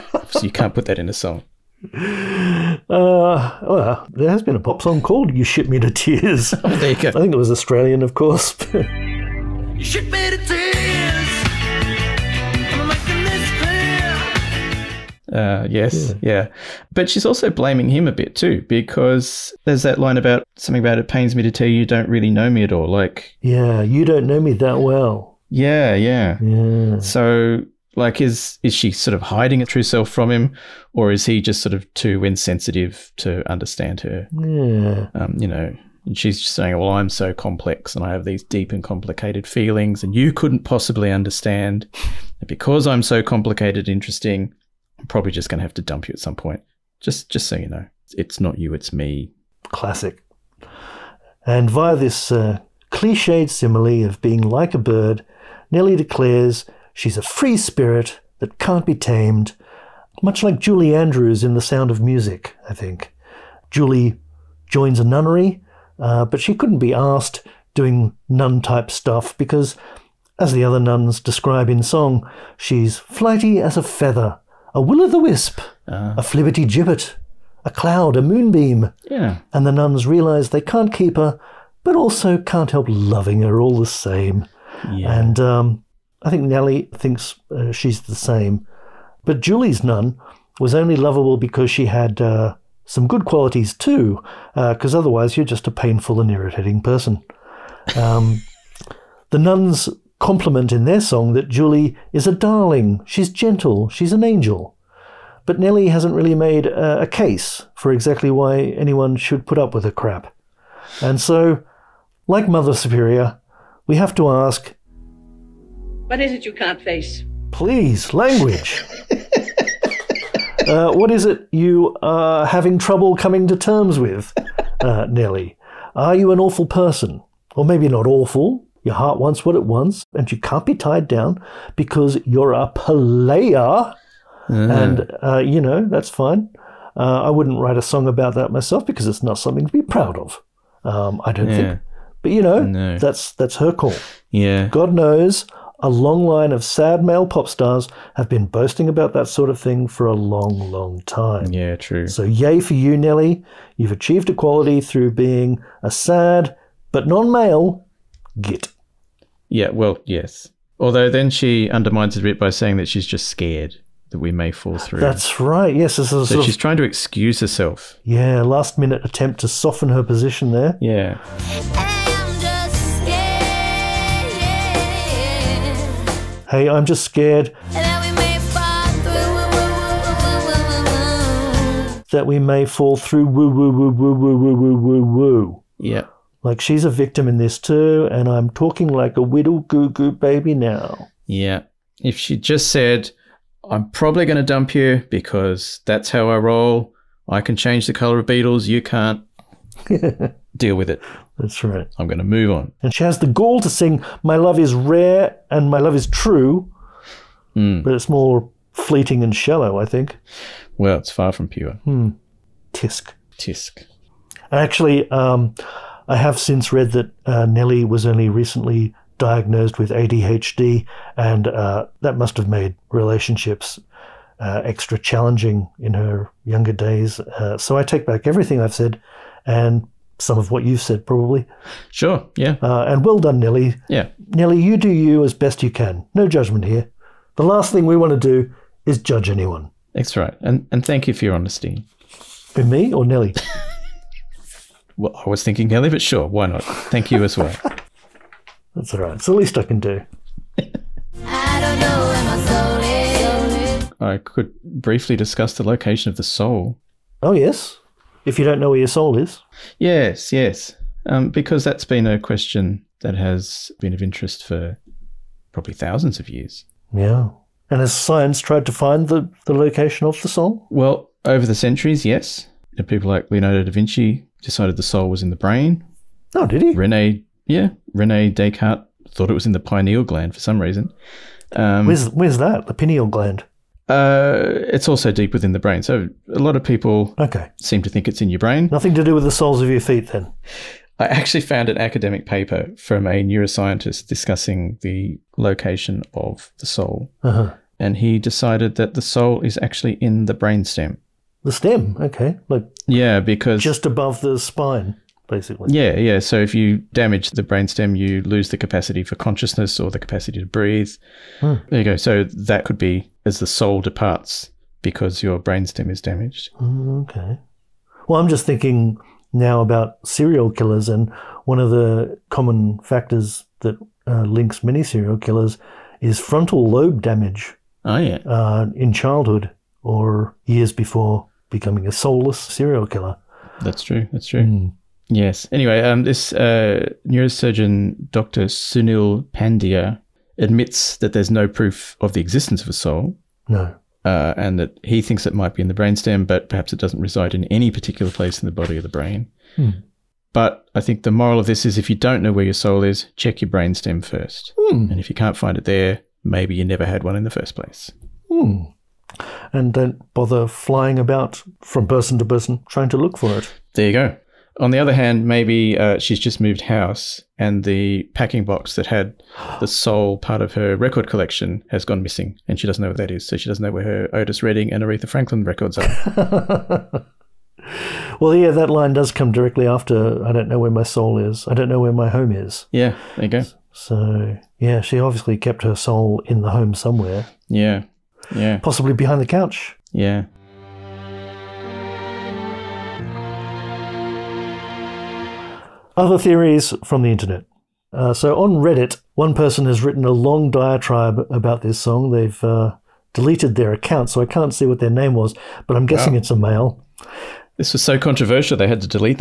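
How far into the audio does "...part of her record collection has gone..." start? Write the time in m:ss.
6:10.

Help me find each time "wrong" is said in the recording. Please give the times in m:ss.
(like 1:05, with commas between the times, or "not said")
not said.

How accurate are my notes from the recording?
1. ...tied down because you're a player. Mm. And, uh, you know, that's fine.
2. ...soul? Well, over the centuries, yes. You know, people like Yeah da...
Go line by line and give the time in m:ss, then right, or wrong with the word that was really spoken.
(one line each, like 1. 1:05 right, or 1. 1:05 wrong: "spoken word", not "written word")
1. 2:10 right
2. 4:30 wrong: "Leonardo", not "Yeah".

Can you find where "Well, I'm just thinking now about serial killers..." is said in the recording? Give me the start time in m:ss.
5:18.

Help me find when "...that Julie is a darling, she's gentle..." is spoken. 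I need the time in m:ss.
1:41.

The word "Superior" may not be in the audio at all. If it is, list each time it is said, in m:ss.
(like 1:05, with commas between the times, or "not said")
1:52.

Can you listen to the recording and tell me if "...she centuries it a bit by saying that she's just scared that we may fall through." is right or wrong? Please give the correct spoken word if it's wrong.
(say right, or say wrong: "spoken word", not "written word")
wrong: "undermines", not "centuries".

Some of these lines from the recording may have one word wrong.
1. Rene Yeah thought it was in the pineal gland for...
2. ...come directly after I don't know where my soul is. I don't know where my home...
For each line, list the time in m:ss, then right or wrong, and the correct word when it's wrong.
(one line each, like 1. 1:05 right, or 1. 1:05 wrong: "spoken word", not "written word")
1. 4:37 wrong: "Descartes", not "Yeah"
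2. 6:19 right.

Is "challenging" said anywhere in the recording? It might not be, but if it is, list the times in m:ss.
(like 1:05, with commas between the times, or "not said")
3:44.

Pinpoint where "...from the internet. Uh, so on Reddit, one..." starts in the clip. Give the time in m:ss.
6:36.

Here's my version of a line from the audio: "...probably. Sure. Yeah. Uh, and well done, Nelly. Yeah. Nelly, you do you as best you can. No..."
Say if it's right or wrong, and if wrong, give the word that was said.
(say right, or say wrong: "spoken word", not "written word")
right.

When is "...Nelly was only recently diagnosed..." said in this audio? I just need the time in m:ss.
3:37.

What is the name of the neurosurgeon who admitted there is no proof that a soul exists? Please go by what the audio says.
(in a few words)
Sunil Pandya.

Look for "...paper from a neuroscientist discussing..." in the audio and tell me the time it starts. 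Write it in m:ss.
4:52.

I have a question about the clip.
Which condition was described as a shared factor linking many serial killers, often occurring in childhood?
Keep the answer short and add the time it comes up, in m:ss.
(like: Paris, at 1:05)
Frontal lobe damage, at 5:26.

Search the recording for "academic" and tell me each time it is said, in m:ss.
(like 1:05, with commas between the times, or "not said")
4:51.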